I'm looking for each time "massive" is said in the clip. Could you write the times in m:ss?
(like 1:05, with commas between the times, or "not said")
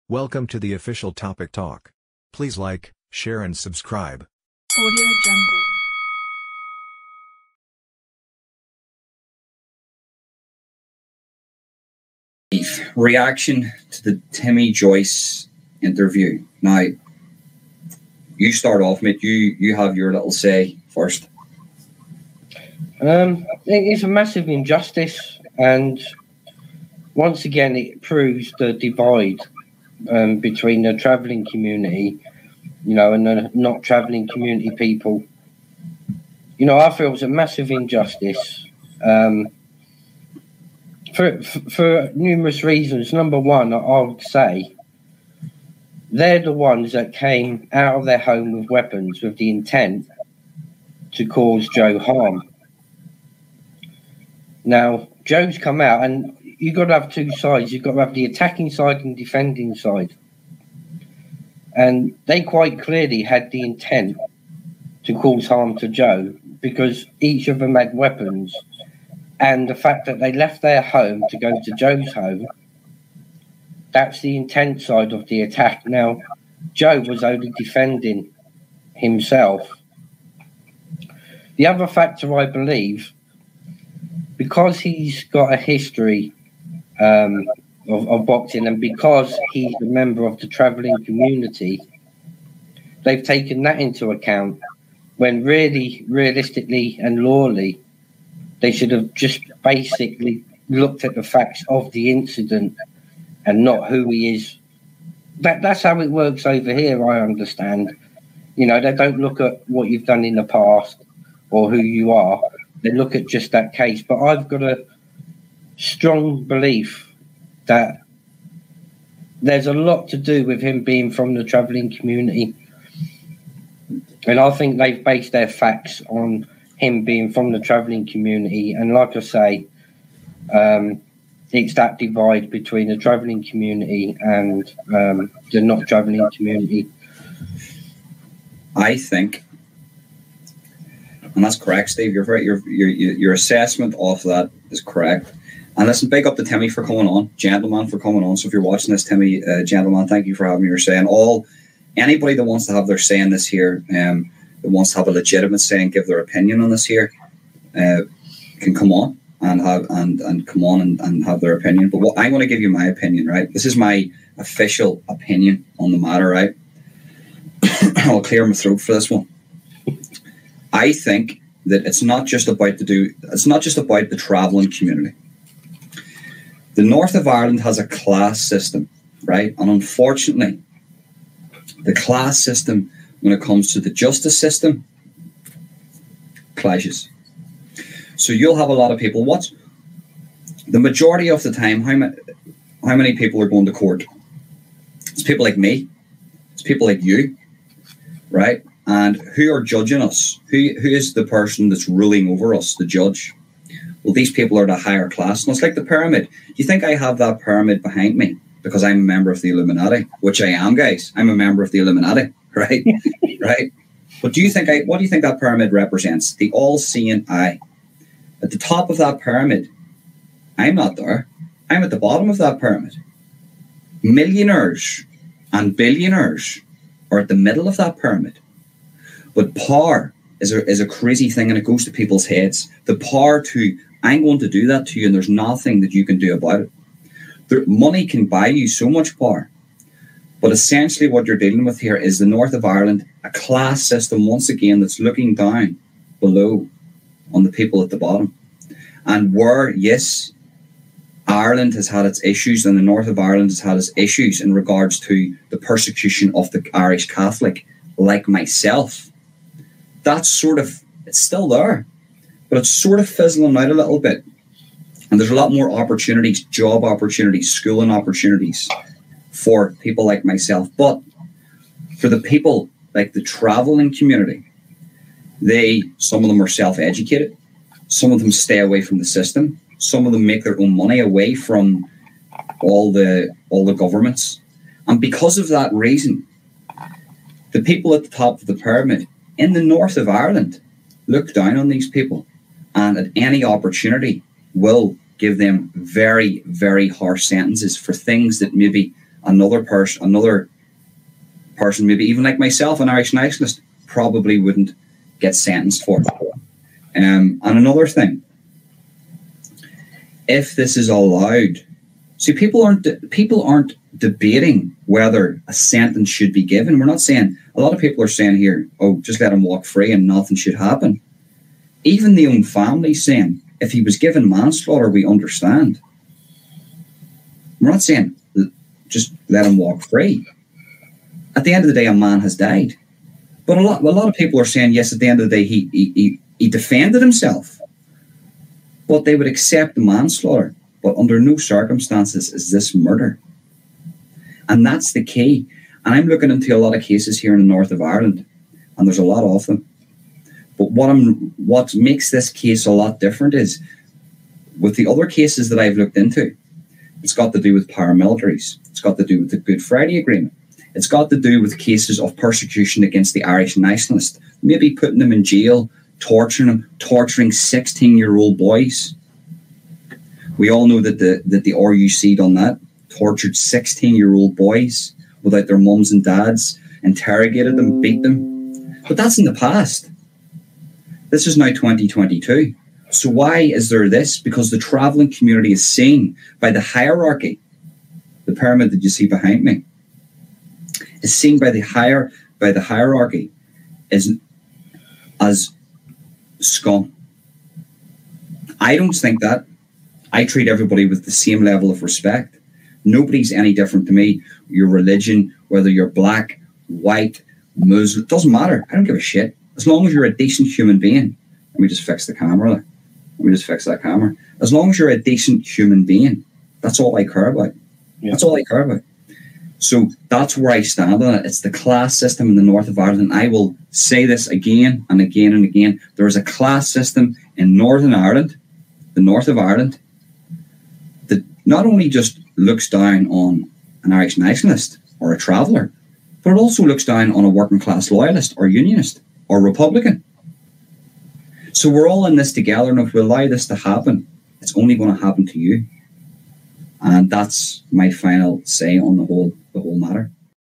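0:24, 0:37.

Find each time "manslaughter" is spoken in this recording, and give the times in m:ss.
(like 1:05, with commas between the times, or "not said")
5:24, 5:39.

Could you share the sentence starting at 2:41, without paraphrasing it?
But what i want to give you my opinion, right?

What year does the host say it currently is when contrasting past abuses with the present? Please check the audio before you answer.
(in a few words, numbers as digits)
2022.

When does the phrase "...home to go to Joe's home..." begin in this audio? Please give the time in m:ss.
1:10.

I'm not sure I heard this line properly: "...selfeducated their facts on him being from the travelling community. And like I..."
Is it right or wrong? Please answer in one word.
wrong.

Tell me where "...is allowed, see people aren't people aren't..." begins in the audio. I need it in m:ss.
5:10.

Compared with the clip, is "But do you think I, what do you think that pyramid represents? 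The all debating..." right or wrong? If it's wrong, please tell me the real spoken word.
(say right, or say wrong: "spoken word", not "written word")
wrong: "seeing", not "debating".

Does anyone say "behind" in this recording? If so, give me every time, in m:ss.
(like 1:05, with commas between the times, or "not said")
3:27, 6:29.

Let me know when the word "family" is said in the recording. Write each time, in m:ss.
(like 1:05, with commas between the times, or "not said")
5:22.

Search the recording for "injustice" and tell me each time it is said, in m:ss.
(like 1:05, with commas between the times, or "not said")
0:24, 0:37.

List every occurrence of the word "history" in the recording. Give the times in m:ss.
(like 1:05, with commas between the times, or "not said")
1:25.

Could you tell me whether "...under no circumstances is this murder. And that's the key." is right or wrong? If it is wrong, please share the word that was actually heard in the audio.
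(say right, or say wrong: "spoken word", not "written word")
right.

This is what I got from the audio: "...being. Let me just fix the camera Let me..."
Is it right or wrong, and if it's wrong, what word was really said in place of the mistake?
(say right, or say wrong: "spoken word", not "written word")
right.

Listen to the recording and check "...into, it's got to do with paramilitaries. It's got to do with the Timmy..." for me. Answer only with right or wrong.
wrong.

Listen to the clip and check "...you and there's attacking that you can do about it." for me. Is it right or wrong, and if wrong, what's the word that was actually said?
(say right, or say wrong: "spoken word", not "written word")
wrong: "nothing", not "attacking".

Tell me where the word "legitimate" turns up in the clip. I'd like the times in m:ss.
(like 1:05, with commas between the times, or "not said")
2:35.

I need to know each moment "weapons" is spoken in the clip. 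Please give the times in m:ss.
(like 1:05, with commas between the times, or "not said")
0:48, 1:07.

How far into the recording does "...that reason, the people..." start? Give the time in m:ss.
4:45.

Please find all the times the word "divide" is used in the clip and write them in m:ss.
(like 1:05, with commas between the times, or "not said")
0:28, 2:11.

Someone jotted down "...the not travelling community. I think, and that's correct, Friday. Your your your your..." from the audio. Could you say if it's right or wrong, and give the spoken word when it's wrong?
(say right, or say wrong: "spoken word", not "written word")
wrong: "Steve", not "Friday".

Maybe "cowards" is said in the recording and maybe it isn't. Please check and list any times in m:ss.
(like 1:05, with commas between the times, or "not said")
not said.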